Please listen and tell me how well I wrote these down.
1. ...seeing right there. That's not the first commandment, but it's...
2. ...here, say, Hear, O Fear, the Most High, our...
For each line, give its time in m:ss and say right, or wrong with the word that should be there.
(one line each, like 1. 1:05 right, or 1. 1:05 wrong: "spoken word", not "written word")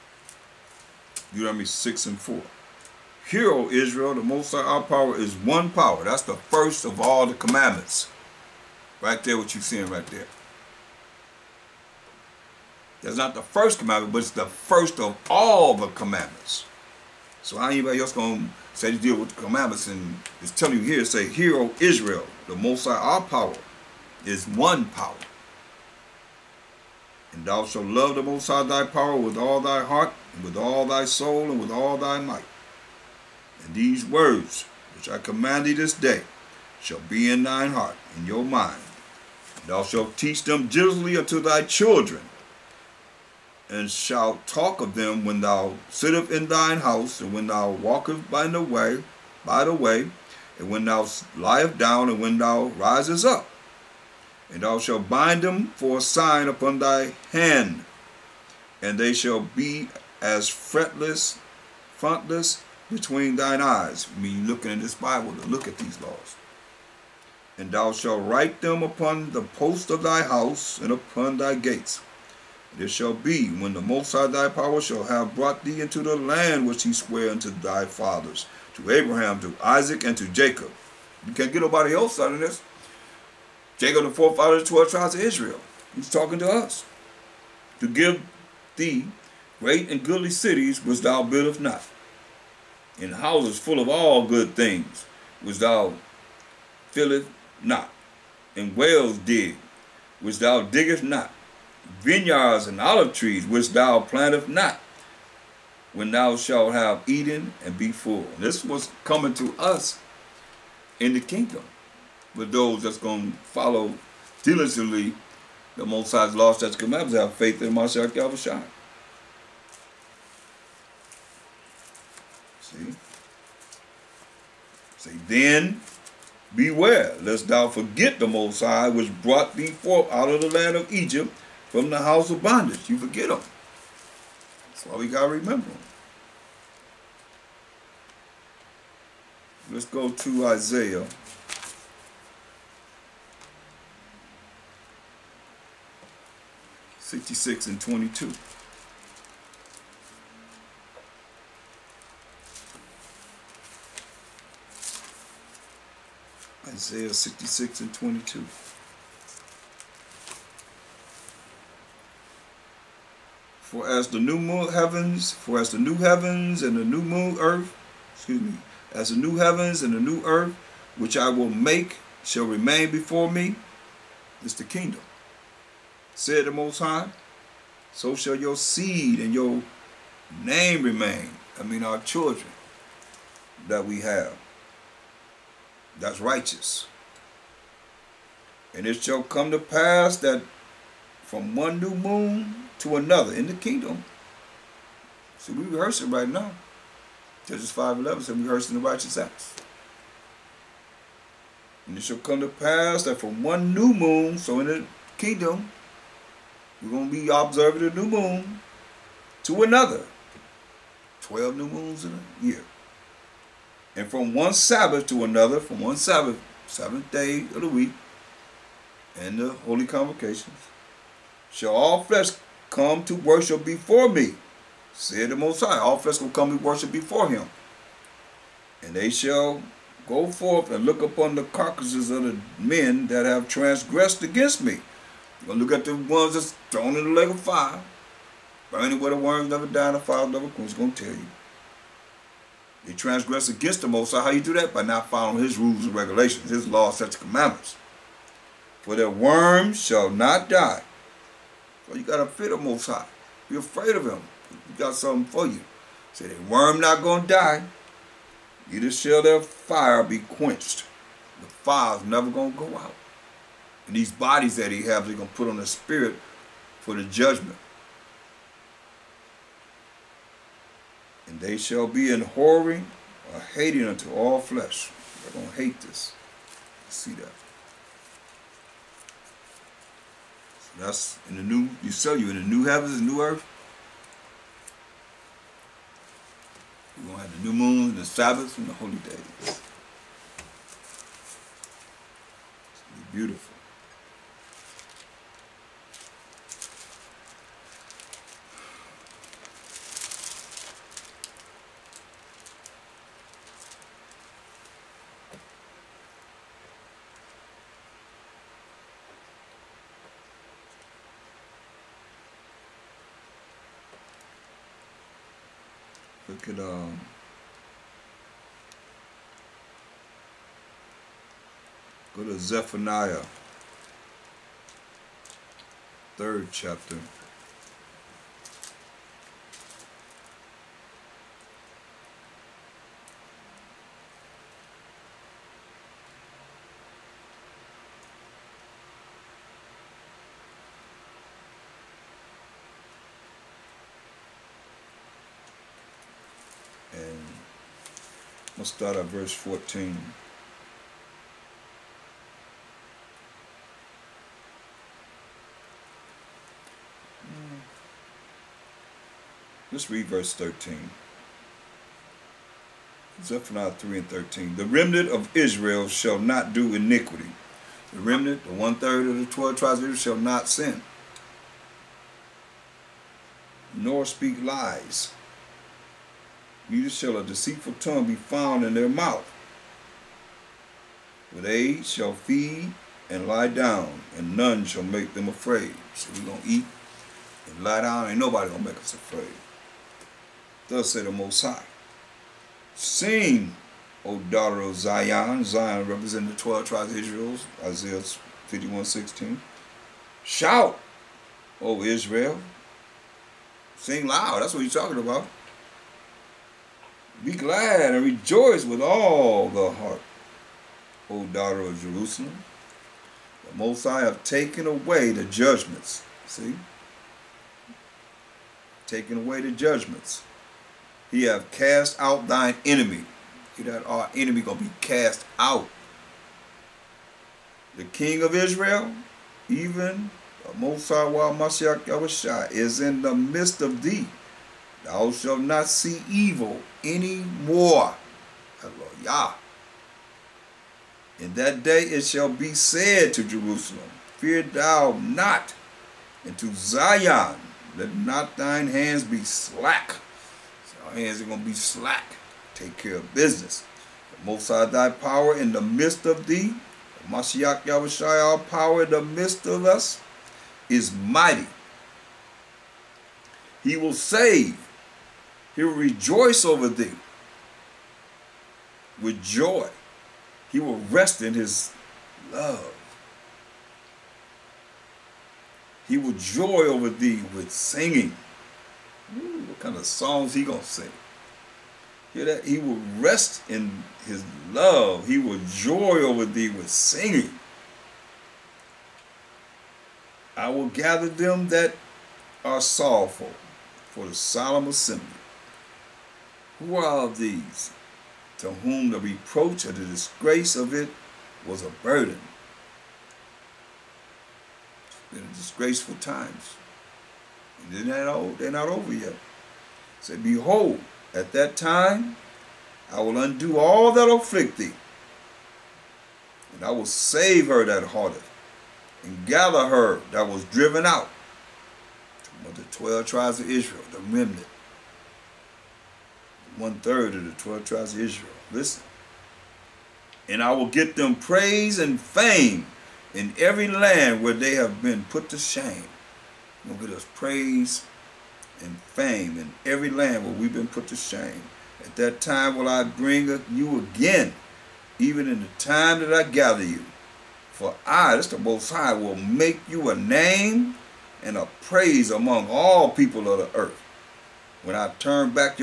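1. 0:09 right
2. 0:20 wrong: "Israel", not "Fear".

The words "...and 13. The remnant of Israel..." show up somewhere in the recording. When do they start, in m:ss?
6:03.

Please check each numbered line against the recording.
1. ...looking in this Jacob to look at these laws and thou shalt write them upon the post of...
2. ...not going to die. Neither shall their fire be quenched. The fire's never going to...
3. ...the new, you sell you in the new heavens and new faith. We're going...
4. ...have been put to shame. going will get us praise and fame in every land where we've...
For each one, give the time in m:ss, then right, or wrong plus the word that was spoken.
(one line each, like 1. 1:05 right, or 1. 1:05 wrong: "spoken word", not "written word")
1. 1:04 wrong: "Bible", not "Jacob"
2. 4:16 right
3. 4:41 wrong: "earth", not "faith"
4. 8:54 right.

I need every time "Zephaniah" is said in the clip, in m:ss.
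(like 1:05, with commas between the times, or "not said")
5:22, 6:03.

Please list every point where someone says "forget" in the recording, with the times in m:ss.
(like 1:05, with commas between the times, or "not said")
2:07, 2:12.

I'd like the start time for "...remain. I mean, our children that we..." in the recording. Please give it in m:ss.
3:00.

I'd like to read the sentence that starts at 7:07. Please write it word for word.
The king of Israel, even Mosai Wa Mashiach Yahushua, is in the midst of thee.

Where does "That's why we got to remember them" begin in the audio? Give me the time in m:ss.
2:14.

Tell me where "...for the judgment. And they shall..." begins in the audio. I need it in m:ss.
4:26.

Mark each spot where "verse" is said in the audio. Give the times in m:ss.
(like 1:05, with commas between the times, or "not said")
5:49, 6:00.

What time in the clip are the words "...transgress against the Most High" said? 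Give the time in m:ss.
4:02.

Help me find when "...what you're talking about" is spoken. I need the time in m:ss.
6:44.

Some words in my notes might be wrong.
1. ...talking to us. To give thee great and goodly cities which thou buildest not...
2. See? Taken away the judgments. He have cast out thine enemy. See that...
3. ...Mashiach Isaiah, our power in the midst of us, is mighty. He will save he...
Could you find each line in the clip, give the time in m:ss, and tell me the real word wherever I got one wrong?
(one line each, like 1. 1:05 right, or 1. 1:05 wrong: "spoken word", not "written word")
1. 1:26 right
2. 6:56 right
3. 7:37 wrong: "Yahushai", not "Isaiah".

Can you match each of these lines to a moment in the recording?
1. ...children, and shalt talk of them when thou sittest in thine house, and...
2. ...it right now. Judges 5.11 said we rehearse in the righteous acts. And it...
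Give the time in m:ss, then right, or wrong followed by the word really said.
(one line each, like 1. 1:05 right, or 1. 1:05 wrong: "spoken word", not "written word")
1. 0:41 right
2. 3:16 right.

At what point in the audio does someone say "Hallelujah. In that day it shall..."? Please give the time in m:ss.
7:18.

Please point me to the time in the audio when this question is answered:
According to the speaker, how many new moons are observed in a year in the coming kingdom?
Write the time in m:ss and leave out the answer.
3:31.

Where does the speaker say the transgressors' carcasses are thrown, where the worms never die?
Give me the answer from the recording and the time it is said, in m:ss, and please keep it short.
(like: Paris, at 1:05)
lake of fire, at 3:57.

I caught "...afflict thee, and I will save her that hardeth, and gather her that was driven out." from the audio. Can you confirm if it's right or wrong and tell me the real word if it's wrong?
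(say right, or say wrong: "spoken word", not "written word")
right.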